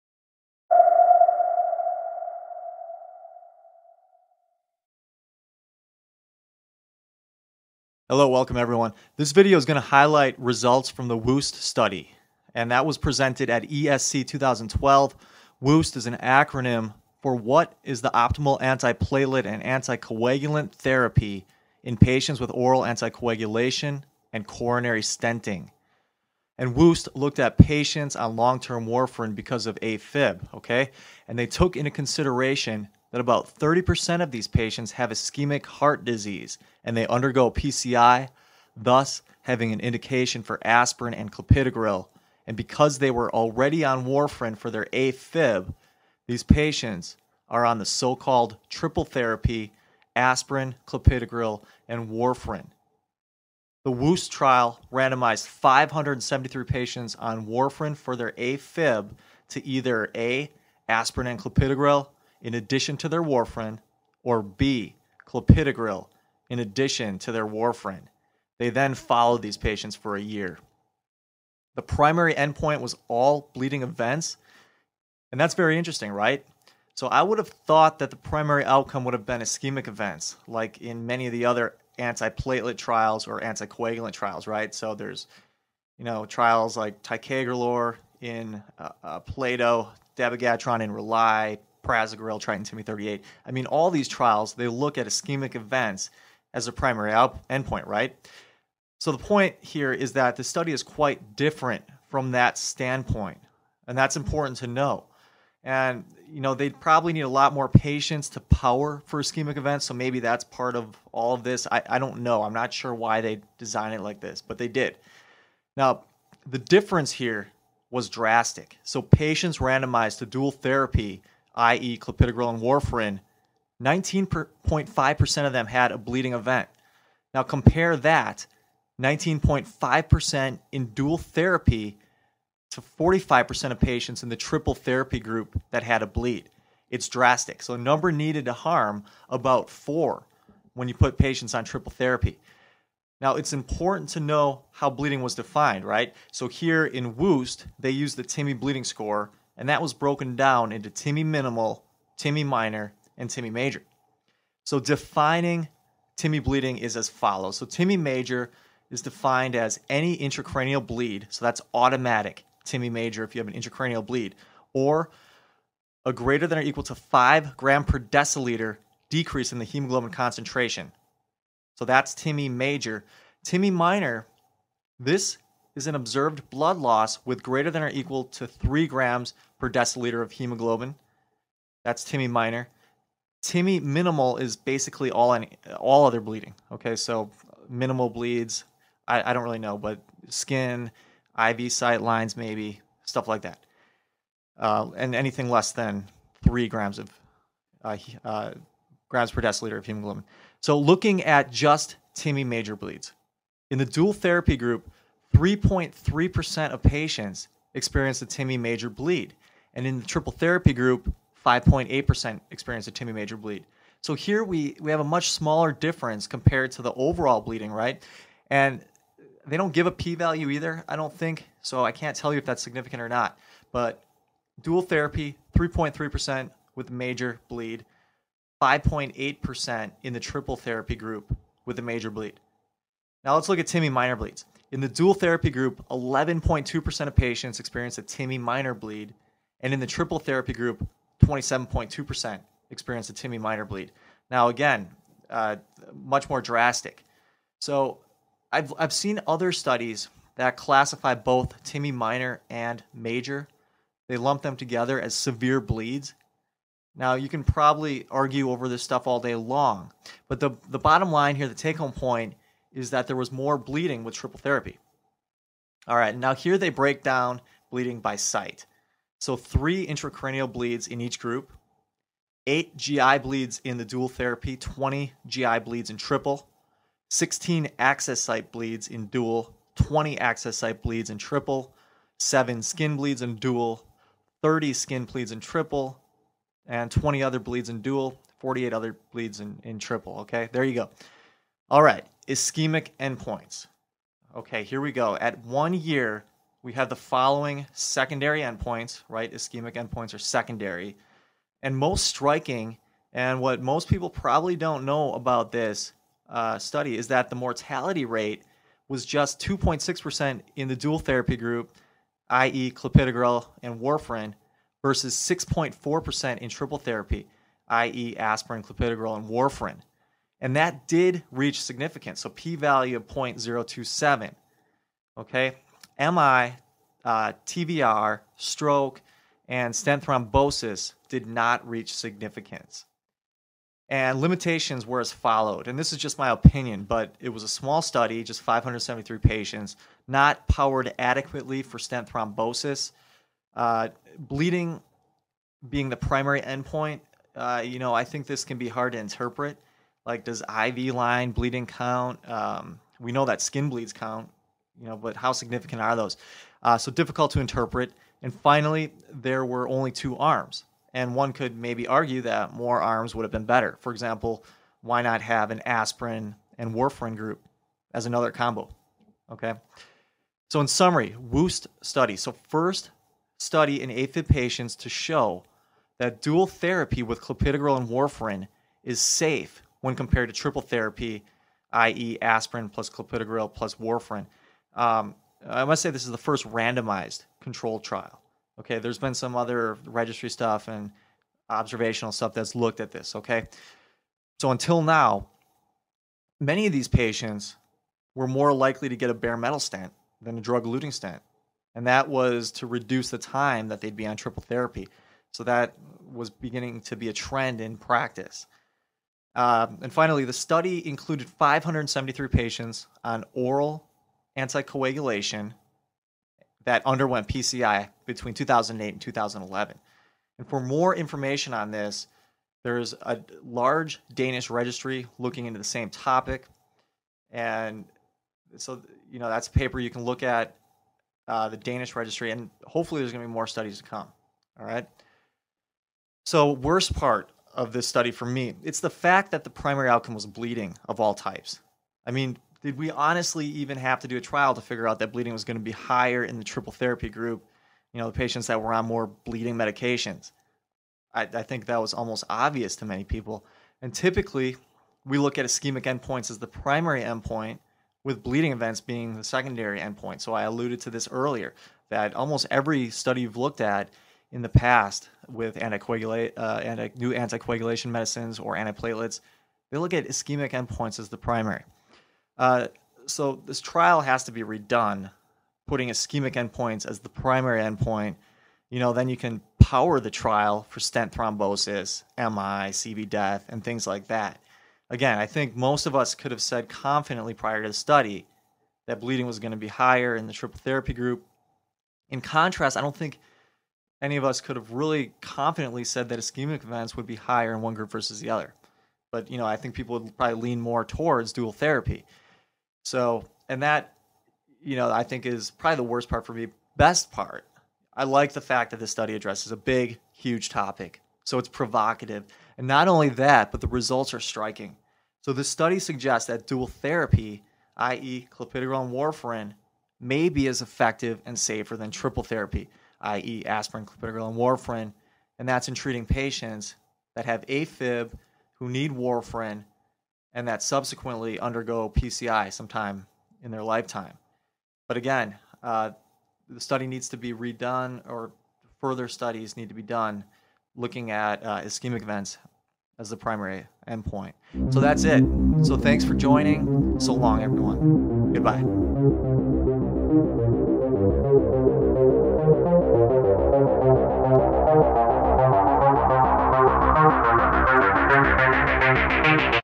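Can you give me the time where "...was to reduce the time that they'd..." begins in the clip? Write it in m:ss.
6:42.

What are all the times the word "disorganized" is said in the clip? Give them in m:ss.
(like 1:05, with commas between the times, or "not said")
not said.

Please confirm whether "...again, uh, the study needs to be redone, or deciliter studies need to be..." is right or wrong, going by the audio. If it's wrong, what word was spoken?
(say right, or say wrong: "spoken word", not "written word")
wrong: "further", not "deciliter".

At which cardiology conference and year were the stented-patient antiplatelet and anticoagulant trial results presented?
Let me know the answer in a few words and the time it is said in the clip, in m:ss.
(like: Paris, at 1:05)
ESC 2012, at 0:13.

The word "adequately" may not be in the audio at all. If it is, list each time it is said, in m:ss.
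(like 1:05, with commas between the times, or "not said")
5:40.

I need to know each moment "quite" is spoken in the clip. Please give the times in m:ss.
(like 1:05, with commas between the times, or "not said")
1:40.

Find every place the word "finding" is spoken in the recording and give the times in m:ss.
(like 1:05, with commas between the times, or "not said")
not said.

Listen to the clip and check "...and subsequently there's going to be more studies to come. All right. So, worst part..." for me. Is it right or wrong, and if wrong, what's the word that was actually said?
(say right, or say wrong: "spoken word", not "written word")
wrong: "hopefully", not "subsequently".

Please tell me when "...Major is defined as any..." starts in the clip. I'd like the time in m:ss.
2:37.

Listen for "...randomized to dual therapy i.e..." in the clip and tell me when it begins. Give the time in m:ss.
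1:59.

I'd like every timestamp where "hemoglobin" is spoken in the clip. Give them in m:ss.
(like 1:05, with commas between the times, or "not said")
2:49, 3:00, 3:19.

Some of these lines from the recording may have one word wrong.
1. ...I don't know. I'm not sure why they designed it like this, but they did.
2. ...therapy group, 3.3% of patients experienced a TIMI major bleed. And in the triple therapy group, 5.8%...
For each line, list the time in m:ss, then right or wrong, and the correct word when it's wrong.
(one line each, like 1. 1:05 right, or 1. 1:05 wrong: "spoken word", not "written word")
1. 1:51 right
2. 3:24 right.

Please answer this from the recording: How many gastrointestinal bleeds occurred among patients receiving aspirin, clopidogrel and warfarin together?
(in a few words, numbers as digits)
20.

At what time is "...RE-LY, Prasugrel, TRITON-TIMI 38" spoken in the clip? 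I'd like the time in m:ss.
1:30.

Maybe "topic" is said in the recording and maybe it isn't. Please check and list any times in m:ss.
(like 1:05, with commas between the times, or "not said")
7:05, 8:30.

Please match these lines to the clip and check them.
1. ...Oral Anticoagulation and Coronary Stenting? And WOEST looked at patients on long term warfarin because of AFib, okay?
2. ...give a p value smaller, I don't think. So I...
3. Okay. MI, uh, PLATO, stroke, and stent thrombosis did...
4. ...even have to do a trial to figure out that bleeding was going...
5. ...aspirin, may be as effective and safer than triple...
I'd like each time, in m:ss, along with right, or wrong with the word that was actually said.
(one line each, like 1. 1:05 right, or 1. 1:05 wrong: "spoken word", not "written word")
1. 0:22 right
2. 3:39 wrong: "either", not "smaller"
3. 5:25 wrong: "TVR", not "PLATO"
4. 7:23 right
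5. 8:38 wrong: "warfarin", not "aspirin".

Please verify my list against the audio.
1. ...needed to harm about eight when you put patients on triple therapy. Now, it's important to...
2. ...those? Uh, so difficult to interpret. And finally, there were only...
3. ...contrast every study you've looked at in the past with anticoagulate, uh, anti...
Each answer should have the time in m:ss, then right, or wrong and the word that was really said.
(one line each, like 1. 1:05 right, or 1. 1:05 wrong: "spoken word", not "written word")
1. 2:18 wrong: "four", not "eight"
2. 5:55 right
3. 7:42 wrong: "almost", not "contrast".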